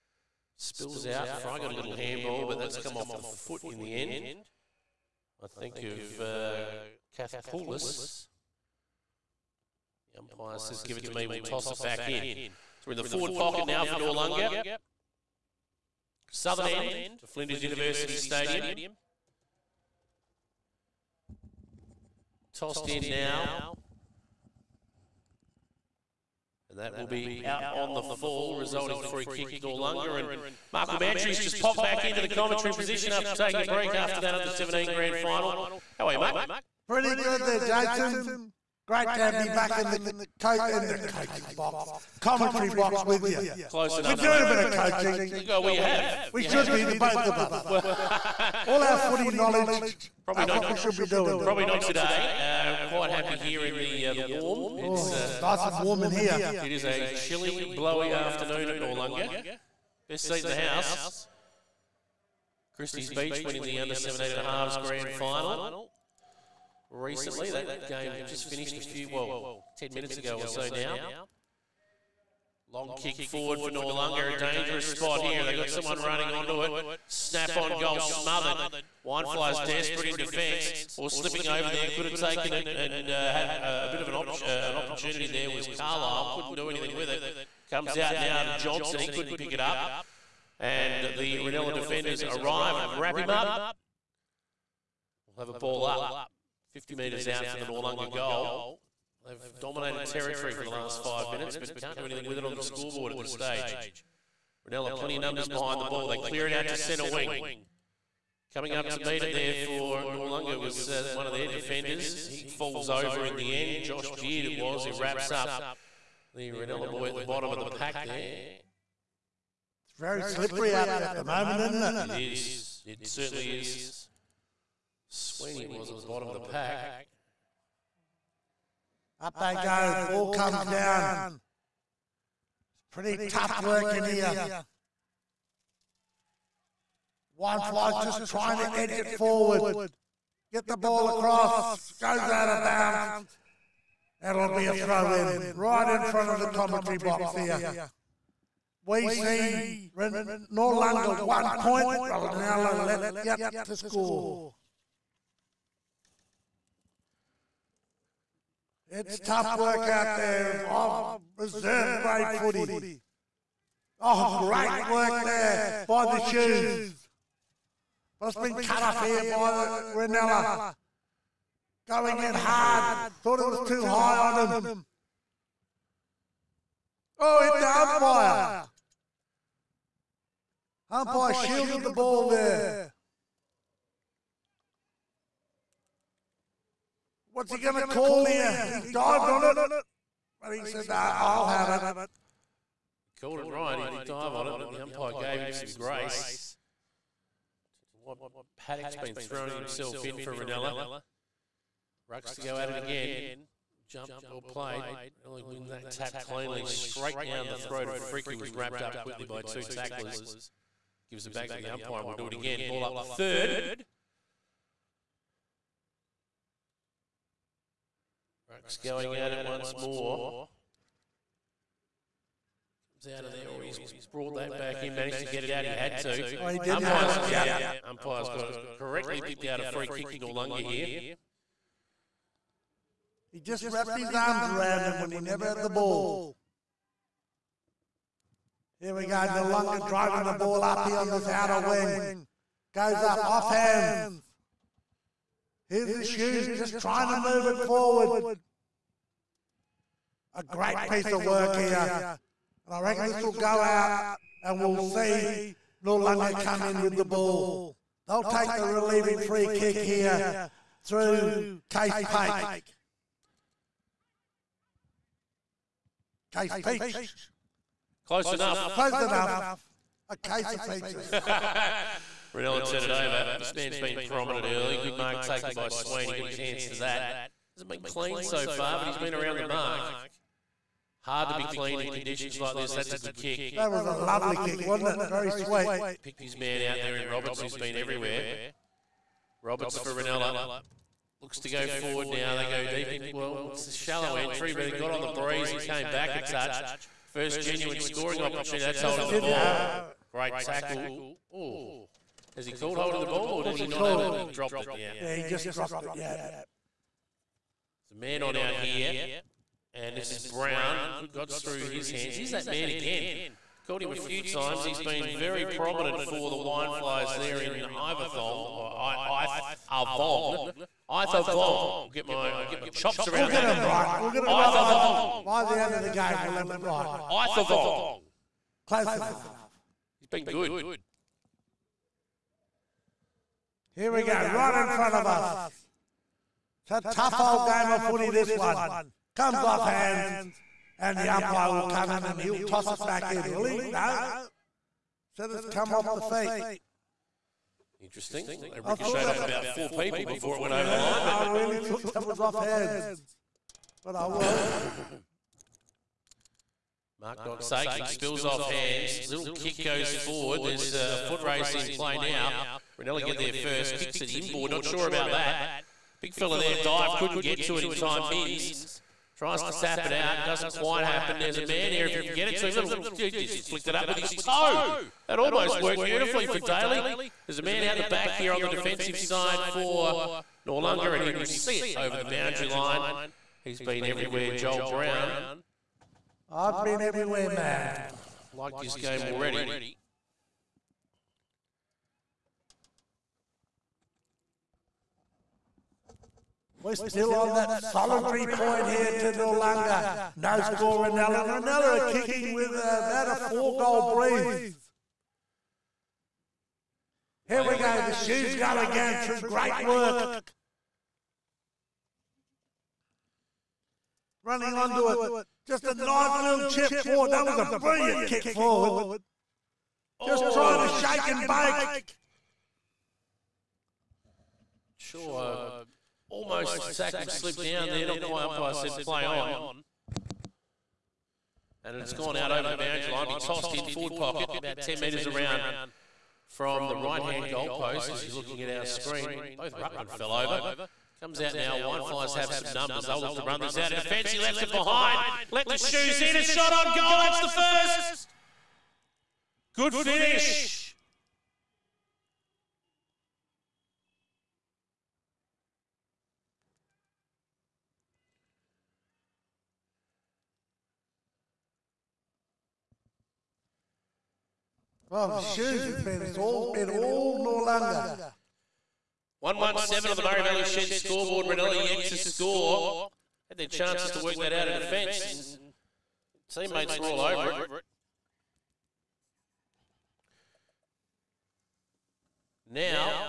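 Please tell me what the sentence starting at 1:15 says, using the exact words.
They got someone running onto it.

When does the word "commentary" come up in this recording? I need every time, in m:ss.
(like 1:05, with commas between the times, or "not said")
0:32, 0:42, 2:26.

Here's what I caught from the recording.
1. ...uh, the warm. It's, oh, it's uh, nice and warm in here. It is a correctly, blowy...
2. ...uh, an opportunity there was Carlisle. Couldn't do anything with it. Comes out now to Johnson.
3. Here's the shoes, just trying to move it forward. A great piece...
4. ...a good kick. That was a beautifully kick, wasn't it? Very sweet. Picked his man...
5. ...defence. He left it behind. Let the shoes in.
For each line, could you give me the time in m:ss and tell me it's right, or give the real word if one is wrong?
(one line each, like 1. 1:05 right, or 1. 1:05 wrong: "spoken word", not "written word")
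1. 0:54 wrong: "chilly", not "correctly"
2. 1:24 right
3. 4:05 right
4. 4:42 wrong: "lovely", not "beautifully"
5. 7:23 right.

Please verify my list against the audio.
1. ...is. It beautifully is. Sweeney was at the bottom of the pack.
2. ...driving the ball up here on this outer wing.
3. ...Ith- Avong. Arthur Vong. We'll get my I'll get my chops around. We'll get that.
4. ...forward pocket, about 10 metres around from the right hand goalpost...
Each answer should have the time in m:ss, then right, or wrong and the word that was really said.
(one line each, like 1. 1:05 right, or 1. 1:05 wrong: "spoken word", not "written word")
1. 2:02 wrong: "certainly", not "beautifully"
2. 3:59 right
3. 5:19 right
4. 7:13 right.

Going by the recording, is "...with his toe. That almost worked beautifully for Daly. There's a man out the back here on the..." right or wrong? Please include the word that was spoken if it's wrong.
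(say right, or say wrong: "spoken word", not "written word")
right.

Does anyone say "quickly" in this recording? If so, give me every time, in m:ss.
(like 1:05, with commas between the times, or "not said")
3:28.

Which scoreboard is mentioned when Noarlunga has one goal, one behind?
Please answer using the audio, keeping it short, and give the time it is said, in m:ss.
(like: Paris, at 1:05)
Murray Valley Shed, at 7:50.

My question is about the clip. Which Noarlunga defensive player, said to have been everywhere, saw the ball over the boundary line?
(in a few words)
Joel Brown.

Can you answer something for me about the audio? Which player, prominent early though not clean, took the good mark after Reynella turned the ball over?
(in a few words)
Swain.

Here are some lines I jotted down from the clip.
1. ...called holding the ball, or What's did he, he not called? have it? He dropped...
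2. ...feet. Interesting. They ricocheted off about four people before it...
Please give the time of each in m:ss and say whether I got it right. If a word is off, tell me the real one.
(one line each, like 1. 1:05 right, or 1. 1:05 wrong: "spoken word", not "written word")
1. 5:02 right
2. 5:46 right.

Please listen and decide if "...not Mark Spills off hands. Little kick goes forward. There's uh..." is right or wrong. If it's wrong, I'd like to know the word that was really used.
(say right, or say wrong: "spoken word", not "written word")
wrong: "Saken", not "Mark".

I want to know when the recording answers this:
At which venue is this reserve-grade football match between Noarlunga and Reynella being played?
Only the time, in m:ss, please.
0:17.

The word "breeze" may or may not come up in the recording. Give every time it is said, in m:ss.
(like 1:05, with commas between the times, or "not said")
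4:55, 6:43.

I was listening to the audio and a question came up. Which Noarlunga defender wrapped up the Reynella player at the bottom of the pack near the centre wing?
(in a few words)
Josh Beard.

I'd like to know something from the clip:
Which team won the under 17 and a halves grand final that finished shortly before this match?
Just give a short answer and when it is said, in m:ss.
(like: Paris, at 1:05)
Christie's Beach, at 1:02.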